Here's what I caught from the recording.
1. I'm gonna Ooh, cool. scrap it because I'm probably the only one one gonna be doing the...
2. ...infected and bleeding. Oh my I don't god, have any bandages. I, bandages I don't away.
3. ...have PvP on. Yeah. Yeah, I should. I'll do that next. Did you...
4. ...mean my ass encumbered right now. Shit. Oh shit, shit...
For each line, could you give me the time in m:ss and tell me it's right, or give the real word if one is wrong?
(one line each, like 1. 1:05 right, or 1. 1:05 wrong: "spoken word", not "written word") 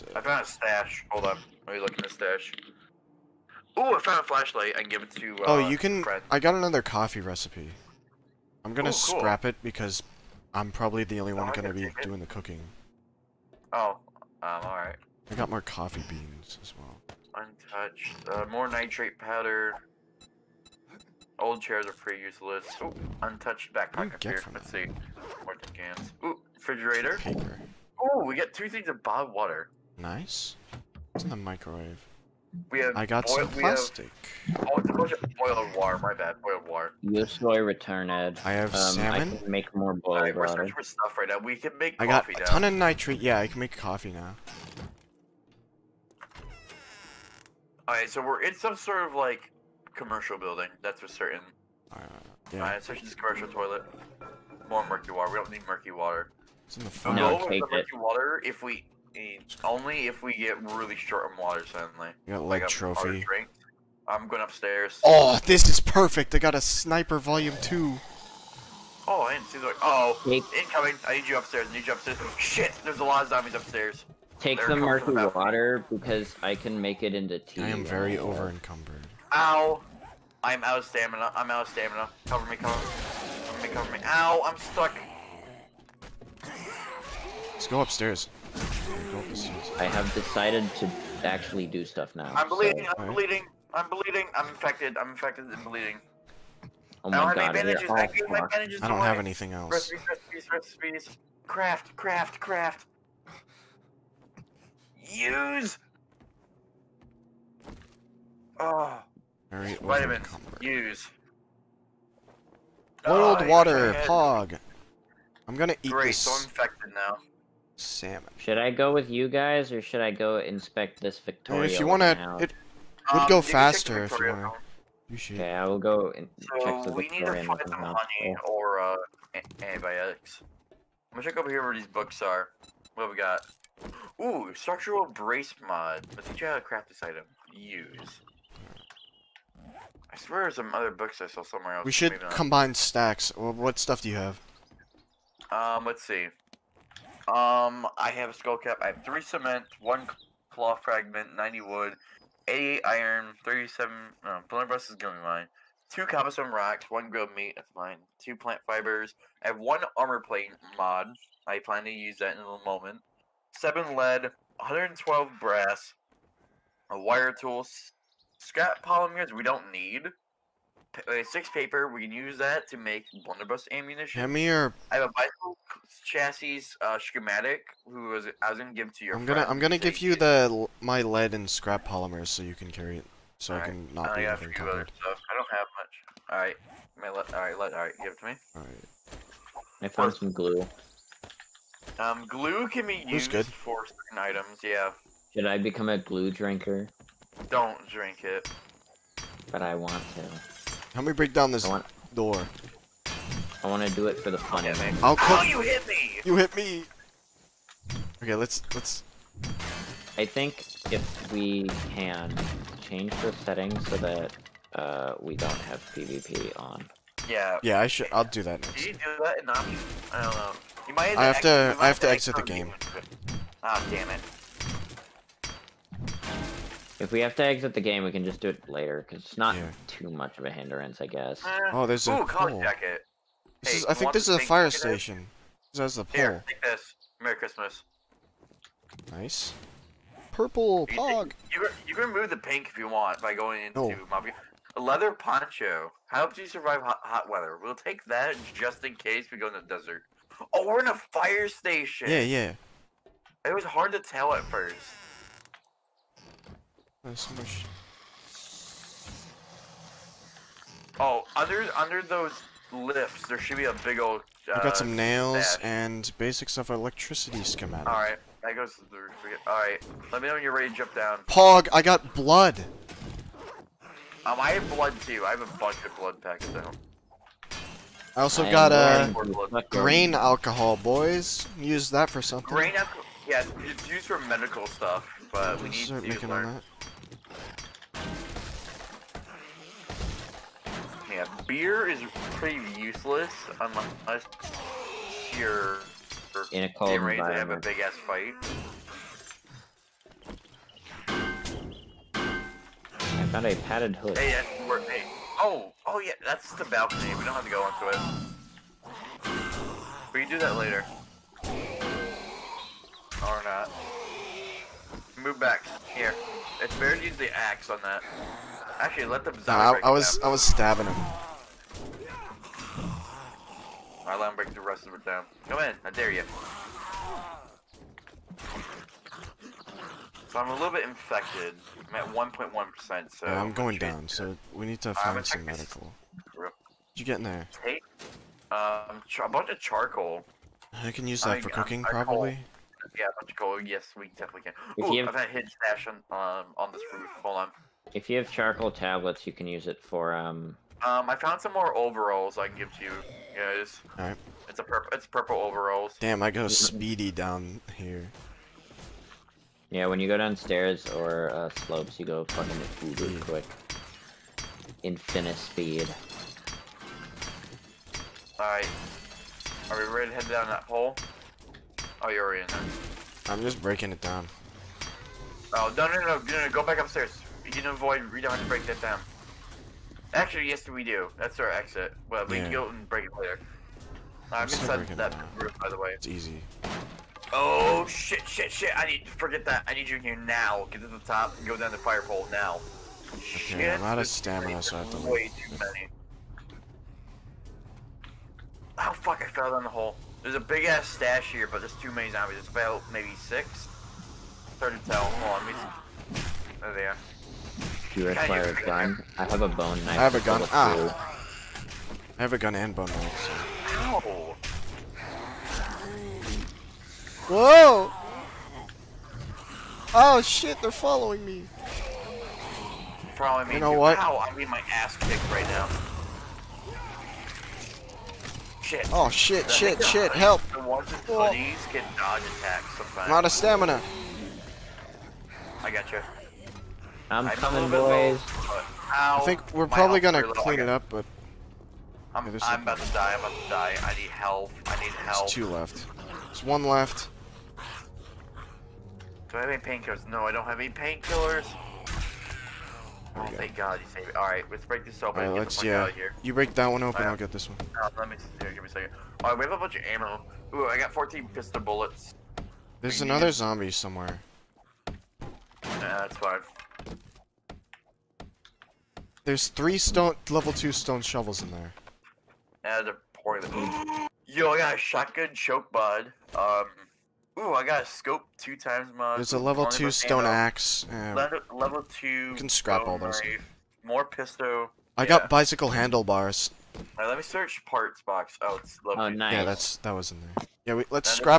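1. 0:08 right
2. 1:35 right
3. 3:35 right
4. 7:04 wrong: "kicked", not "encumbered".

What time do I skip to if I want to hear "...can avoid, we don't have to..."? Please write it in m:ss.
6:17.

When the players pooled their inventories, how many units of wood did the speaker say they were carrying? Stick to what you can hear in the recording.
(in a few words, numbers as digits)
90.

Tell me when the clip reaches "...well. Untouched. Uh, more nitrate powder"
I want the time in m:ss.
0:16.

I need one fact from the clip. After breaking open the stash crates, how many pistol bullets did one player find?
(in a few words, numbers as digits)
14.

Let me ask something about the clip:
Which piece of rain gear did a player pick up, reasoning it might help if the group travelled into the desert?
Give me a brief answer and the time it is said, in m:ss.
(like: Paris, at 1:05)
Leather poncho, at 4:04.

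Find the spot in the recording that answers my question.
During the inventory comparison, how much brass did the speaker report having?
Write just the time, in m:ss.
2:44.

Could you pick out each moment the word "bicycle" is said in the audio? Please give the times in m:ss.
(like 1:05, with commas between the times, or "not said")
2:55, 8:05.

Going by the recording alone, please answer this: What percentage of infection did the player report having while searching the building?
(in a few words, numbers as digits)
1.1%.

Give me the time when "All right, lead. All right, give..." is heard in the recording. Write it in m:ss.
3:07.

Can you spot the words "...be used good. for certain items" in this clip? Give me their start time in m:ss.
3:12.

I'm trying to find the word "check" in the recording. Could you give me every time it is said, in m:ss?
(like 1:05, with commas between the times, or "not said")
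2:06, 2:11.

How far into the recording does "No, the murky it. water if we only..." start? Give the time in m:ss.
0:57.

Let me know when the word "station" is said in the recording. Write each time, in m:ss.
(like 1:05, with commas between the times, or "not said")
3:54, 4:11.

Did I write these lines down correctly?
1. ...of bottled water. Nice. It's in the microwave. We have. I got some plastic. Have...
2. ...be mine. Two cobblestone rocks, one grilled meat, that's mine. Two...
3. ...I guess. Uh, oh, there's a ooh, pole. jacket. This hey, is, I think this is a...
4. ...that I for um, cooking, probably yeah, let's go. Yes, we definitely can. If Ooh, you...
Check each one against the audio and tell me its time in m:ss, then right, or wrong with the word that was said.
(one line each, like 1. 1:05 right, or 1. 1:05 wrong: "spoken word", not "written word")
1. 0:28 right
2. 2:35 right
3. 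3:51 right
4. 5:41 right.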